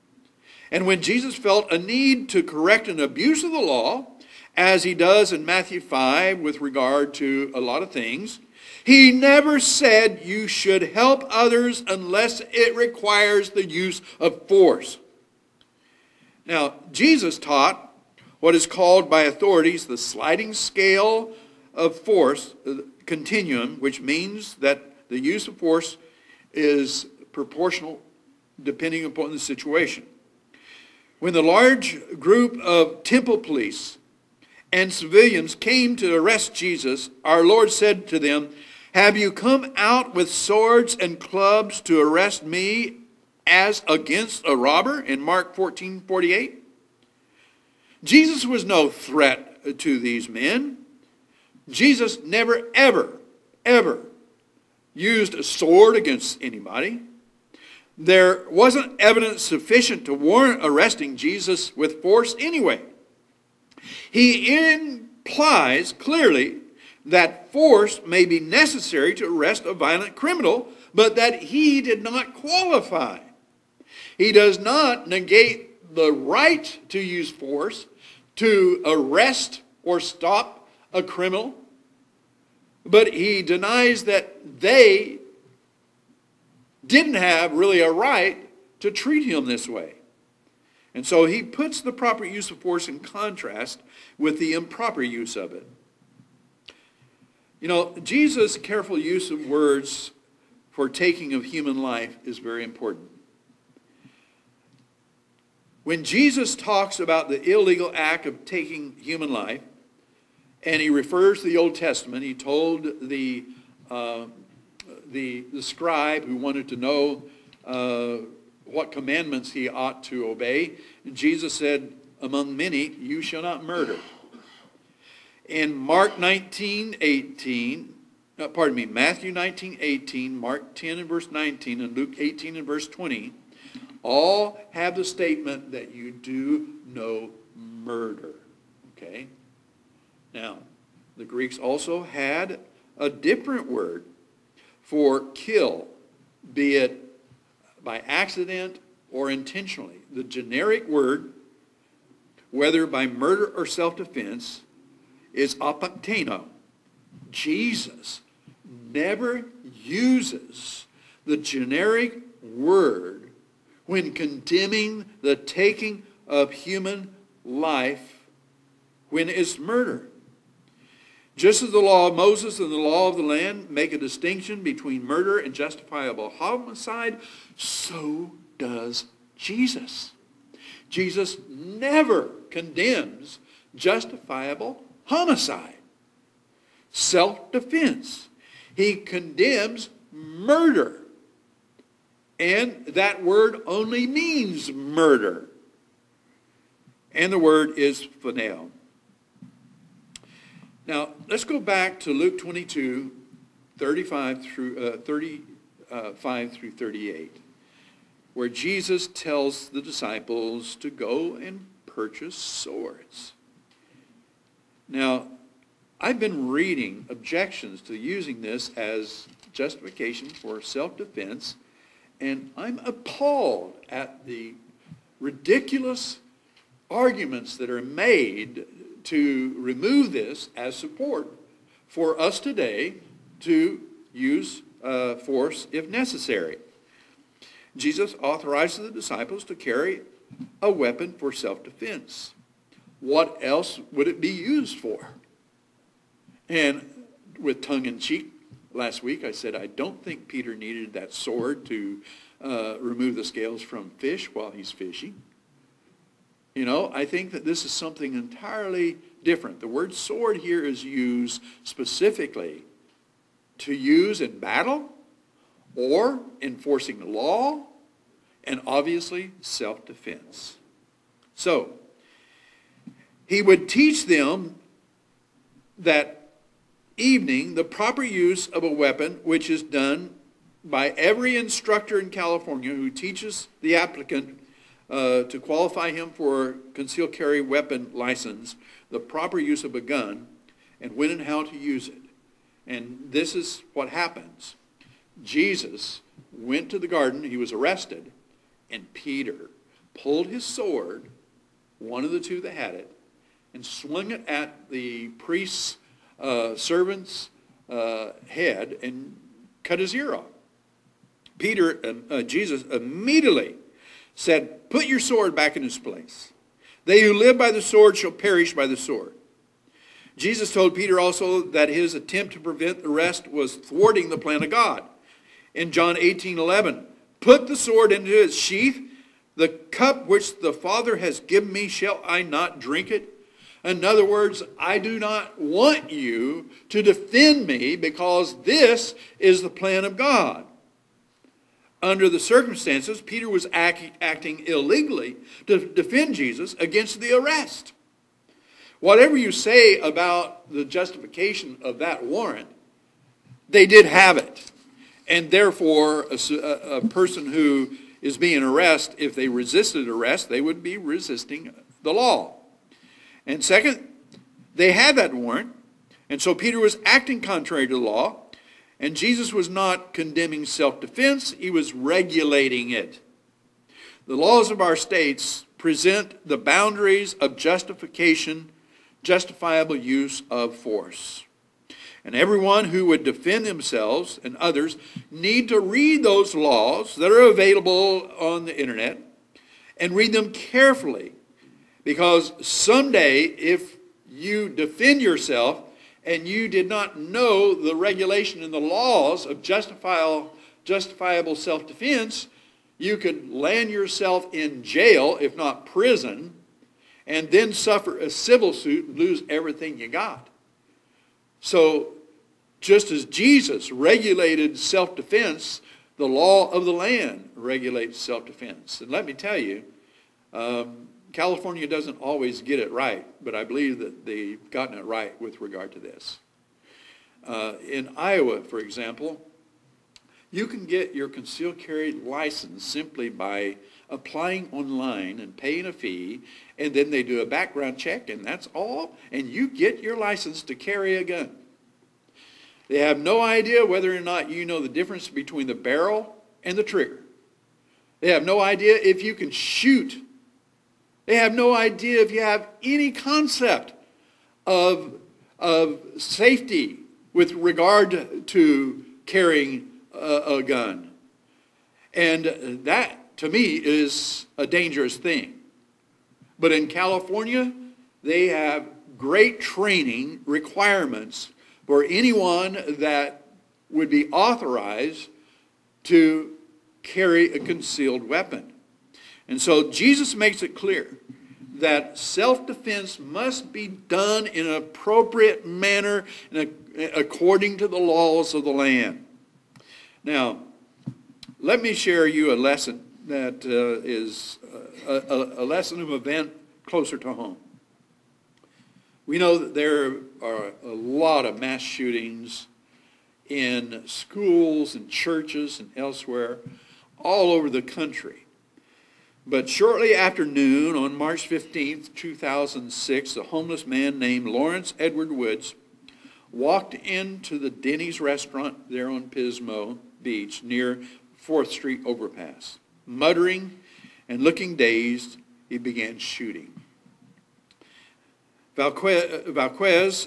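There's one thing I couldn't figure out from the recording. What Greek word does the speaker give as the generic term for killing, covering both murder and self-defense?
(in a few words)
apacteno.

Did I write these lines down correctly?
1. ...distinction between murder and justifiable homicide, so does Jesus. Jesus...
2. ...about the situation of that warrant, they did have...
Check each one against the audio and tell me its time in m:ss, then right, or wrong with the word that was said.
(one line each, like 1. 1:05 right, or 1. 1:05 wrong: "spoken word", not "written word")
1. 2:53 right
2. 5:49 wrong: "justification", not "situation".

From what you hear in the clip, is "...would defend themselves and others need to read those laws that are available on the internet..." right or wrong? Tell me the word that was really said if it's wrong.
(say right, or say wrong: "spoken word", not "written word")
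right.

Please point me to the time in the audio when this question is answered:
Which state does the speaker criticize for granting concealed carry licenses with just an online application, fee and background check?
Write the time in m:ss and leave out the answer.
7:07.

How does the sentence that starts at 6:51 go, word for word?
So, just as Jesus regulated self defense, the law of the land regulates self defense.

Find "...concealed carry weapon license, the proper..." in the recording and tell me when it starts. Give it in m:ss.
4:46.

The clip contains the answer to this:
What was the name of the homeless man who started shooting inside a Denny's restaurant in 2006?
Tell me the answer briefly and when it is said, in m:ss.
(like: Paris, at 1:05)
Lawrence Edward Woods, at 8:34.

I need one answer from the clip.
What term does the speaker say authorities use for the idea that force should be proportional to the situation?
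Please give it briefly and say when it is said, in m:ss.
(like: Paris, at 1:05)
sliding scale of force, at 0:19.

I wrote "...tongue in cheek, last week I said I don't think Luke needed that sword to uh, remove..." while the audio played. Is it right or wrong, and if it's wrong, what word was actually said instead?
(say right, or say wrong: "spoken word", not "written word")
wrong: "Peter", not "Luke".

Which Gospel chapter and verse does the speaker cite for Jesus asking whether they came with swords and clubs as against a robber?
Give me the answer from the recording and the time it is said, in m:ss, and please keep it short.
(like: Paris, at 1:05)
Mark 14:48, at 0:45.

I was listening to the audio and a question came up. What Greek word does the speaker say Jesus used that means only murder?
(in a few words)
phonel.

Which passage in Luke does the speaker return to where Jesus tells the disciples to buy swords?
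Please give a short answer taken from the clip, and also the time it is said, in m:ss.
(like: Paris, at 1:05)
Luke 22:35-38, at 3:22.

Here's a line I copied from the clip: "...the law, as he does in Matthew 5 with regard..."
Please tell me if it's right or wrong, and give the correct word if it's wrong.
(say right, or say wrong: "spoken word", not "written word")
right.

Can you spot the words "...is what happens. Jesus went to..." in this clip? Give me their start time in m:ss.
4:53.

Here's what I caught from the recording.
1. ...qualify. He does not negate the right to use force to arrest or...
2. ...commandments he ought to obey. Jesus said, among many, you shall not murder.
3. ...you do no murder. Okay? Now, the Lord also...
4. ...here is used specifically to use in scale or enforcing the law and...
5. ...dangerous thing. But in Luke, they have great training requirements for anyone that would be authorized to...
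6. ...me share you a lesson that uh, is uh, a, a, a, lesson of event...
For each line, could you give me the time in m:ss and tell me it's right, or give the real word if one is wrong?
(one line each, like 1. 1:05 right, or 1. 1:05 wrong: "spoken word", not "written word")
1. 1:12 right
2. 1:58 right
3. 2:15 wrong: "Greeks", not "Lord"
4. 4:20 wrong: "battle", not "scale"
5. 7:44 wrong: "California", not "Luke"
6. 8:11 right.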